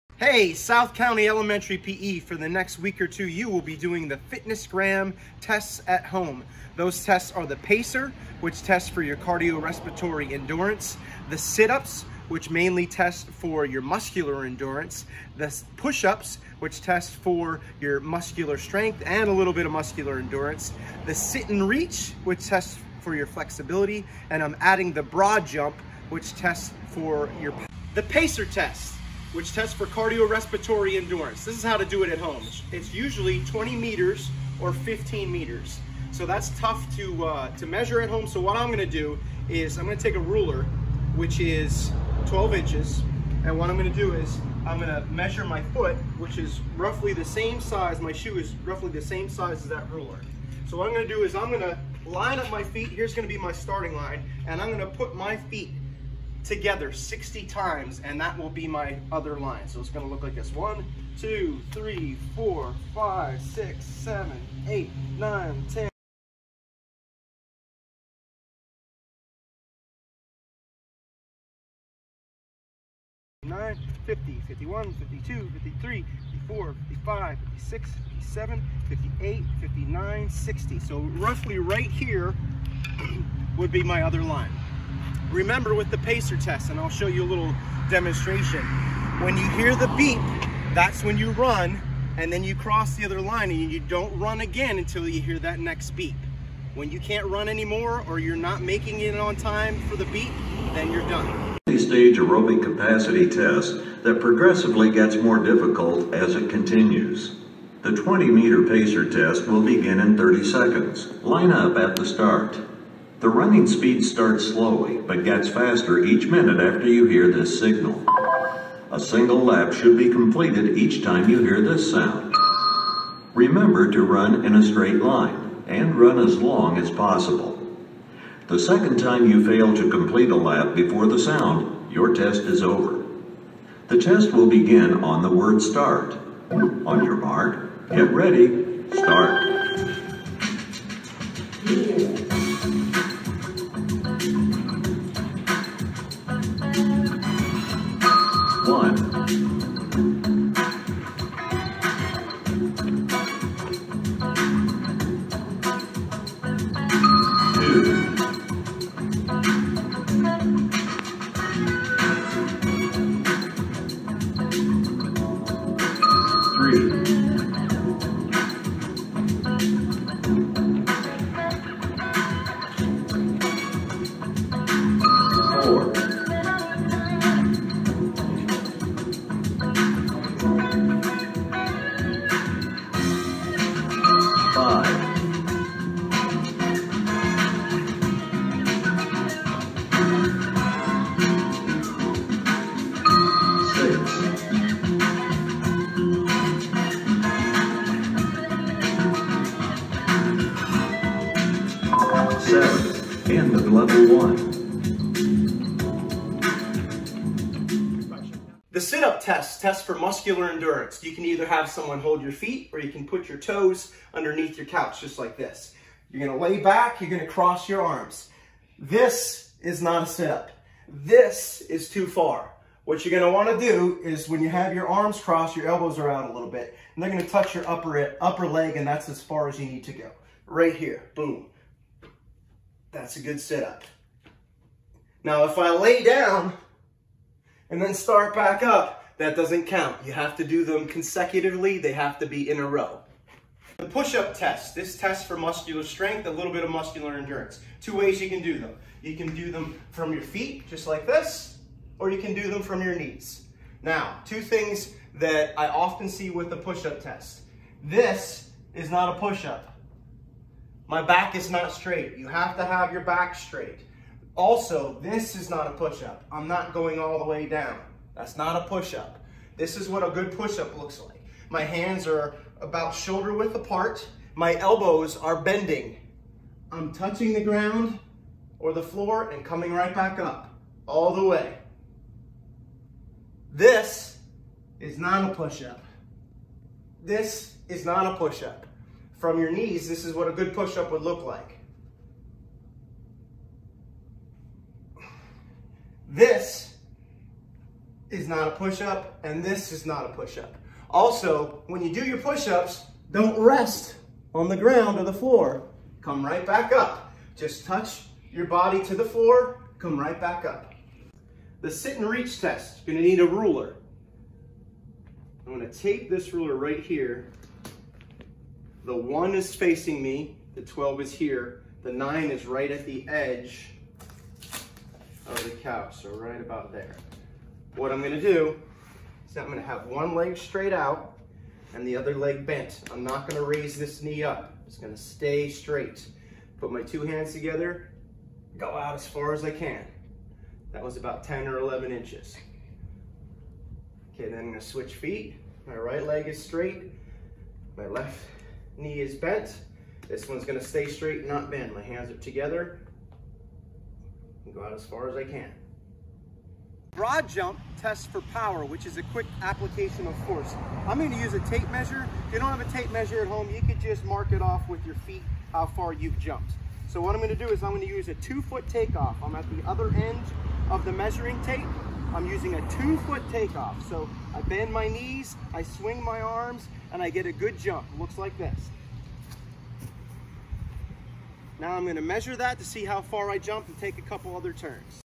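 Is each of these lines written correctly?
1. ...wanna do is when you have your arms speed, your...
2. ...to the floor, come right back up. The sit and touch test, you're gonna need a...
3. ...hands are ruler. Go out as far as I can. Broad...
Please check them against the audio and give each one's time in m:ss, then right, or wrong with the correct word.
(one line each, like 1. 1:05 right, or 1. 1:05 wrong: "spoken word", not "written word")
1. 3:43 wrong: "crossed", not "speed"
2. 5:08 wrong: "reach", not "touch"
3. 5:51 wrong: "together", not "ruler".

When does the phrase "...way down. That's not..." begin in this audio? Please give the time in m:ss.
4:27.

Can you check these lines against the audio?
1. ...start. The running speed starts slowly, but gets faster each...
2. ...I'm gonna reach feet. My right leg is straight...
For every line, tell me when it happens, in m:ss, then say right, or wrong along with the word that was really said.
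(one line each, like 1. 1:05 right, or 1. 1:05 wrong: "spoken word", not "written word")
1. 1:52 right
2. 5:44 wrong: "switch", not "reach".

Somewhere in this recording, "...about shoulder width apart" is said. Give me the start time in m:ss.
4:32.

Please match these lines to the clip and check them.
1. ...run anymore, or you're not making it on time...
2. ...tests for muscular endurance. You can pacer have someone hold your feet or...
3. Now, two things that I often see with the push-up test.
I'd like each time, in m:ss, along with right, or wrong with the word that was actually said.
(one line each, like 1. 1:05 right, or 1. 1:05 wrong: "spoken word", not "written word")
1. 1:37 right
2. 3:29 wrong: "either", not "pacer"
3. 4:13 right.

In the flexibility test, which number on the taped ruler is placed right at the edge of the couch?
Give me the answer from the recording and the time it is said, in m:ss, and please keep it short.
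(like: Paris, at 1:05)
9, at 5:21.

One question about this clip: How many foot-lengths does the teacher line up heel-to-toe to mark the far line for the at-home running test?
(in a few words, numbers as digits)
60.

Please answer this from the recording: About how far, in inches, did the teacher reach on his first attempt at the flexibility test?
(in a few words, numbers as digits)
10 or 11 inches.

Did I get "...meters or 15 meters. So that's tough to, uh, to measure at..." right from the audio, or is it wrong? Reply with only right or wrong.
right.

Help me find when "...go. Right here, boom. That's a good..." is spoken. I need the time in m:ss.
3:49.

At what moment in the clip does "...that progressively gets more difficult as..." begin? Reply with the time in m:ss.
1:44.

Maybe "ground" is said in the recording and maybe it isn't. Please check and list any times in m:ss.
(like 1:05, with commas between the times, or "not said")
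4:37, 5:04.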